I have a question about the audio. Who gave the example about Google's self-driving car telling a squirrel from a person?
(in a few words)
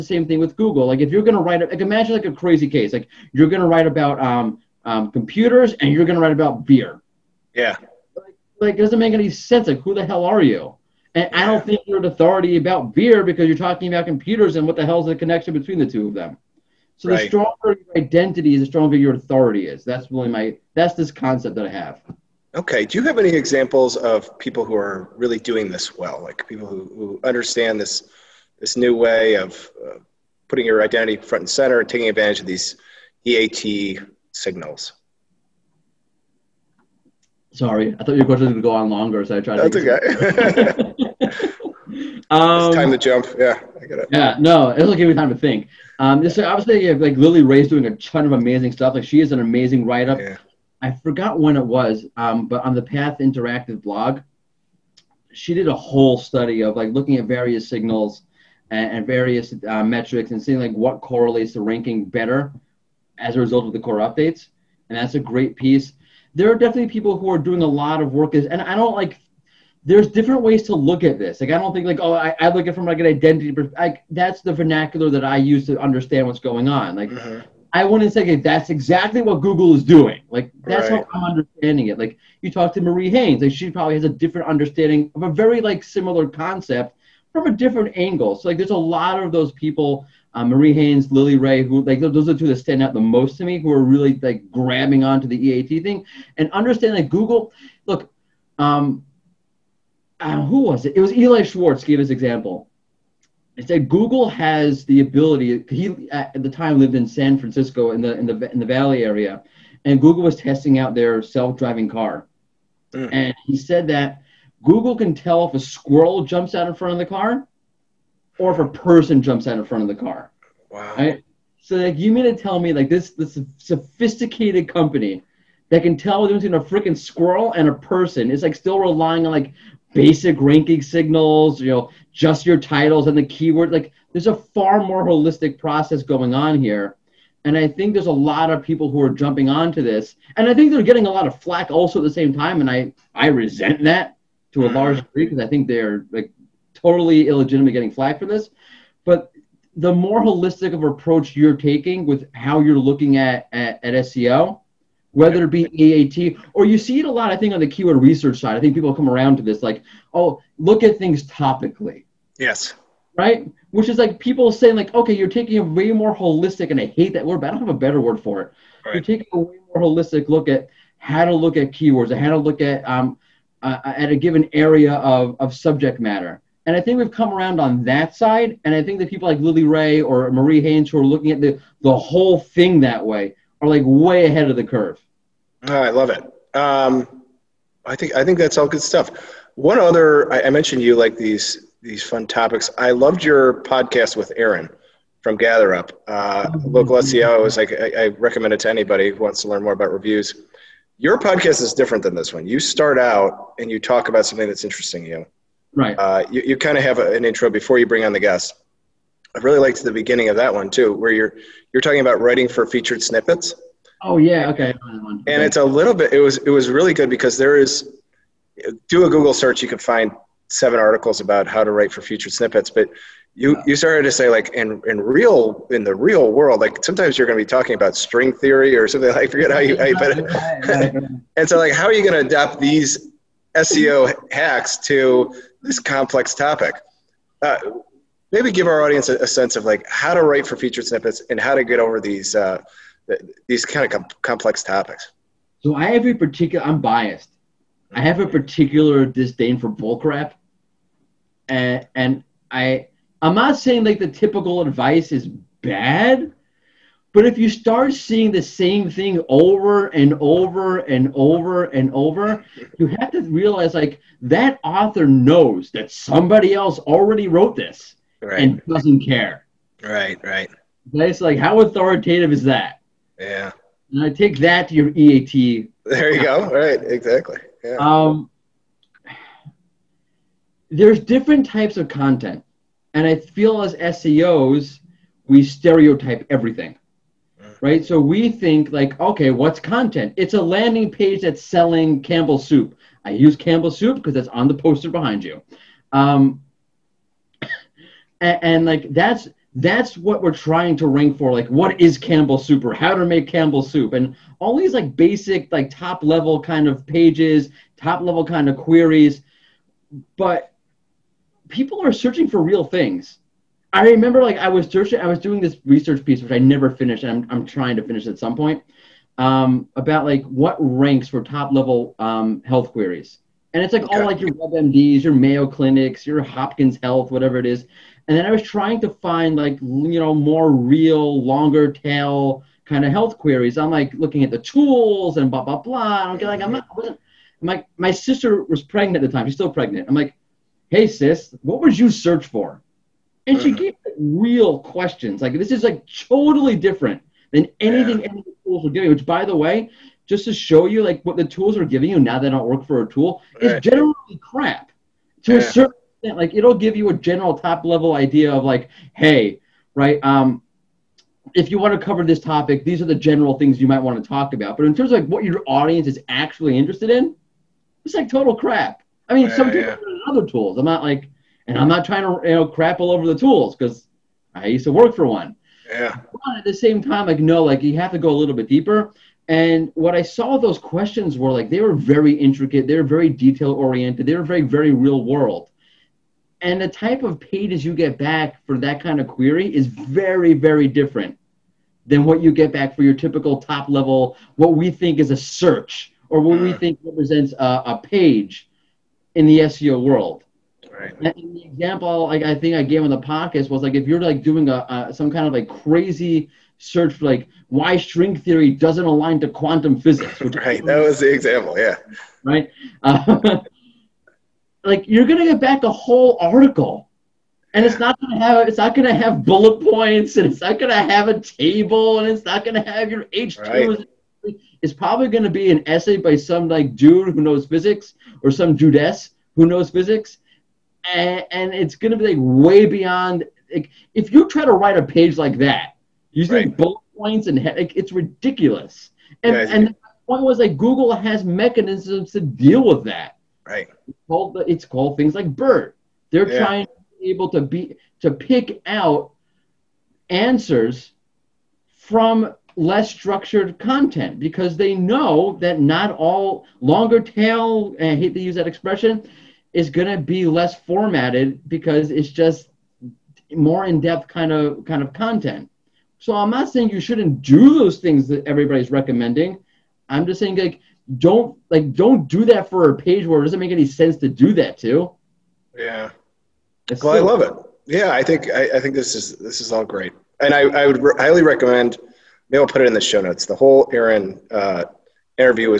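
Eli Schwartz.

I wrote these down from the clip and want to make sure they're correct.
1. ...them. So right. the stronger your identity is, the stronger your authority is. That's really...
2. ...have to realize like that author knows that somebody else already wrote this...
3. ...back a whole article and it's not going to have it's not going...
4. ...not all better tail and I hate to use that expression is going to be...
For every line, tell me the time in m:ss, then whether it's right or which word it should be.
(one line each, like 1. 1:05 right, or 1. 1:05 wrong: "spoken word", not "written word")
1. 0:16 right
2. 4:22 right
3. 6:55 right
4. 7:35 wrong: "longer", not "better".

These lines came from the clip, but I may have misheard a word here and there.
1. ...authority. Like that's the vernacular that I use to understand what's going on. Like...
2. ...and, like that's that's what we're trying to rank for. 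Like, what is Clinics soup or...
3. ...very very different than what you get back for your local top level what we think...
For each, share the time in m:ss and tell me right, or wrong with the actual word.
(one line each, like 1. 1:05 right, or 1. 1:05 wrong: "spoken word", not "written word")
1. 1:13 wrong: "identity", not "authority"
2. 4:58 wrong: "Campbell", not "Clinics"
3. 6:29 wrong: "typical", not "local".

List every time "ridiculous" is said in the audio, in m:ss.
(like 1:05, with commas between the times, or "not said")
7:17.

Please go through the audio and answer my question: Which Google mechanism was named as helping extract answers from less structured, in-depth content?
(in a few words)
BERT.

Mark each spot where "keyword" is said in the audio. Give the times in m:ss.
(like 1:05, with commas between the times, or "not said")
2:13, 2:37, 2:51.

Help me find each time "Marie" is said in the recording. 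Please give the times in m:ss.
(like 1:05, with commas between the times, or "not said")
1:22, 1:30, 3:00.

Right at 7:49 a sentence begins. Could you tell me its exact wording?
I'm just saying like don't like don't do that for a page where it doesn't make any sense to do that to.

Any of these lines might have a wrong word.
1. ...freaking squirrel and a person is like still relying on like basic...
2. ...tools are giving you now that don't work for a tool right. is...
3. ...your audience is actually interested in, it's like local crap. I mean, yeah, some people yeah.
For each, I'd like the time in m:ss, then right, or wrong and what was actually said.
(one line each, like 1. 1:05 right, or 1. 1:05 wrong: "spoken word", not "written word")
1. 2:06 right
2. 5:51 right
3. 6:05 wrong: "total", not "local".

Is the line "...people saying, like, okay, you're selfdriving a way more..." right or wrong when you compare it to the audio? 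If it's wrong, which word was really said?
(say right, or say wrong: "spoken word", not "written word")
wrong: "taking", not "selfdriving".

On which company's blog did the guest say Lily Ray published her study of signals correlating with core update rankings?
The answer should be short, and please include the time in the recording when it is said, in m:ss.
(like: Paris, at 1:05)
Path Interactive, at 0:52.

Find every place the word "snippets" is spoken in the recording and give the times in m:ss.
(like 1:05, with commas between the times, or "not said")
3:33, 3:42, 4:00.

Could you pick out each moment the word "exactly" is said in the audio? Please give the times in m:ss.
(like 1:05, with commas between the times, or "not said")
1:18, 4:36.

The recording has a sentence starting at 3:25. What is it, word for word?
Uh, you you kind of have a, an intro before you bring on the guest.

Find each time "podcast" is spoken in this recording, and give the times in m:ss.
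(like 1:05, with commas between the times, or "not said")
3:13, 3:21, 6:43.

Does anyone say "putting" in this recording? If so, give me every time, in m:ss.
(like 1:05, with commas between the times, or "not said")
0:30.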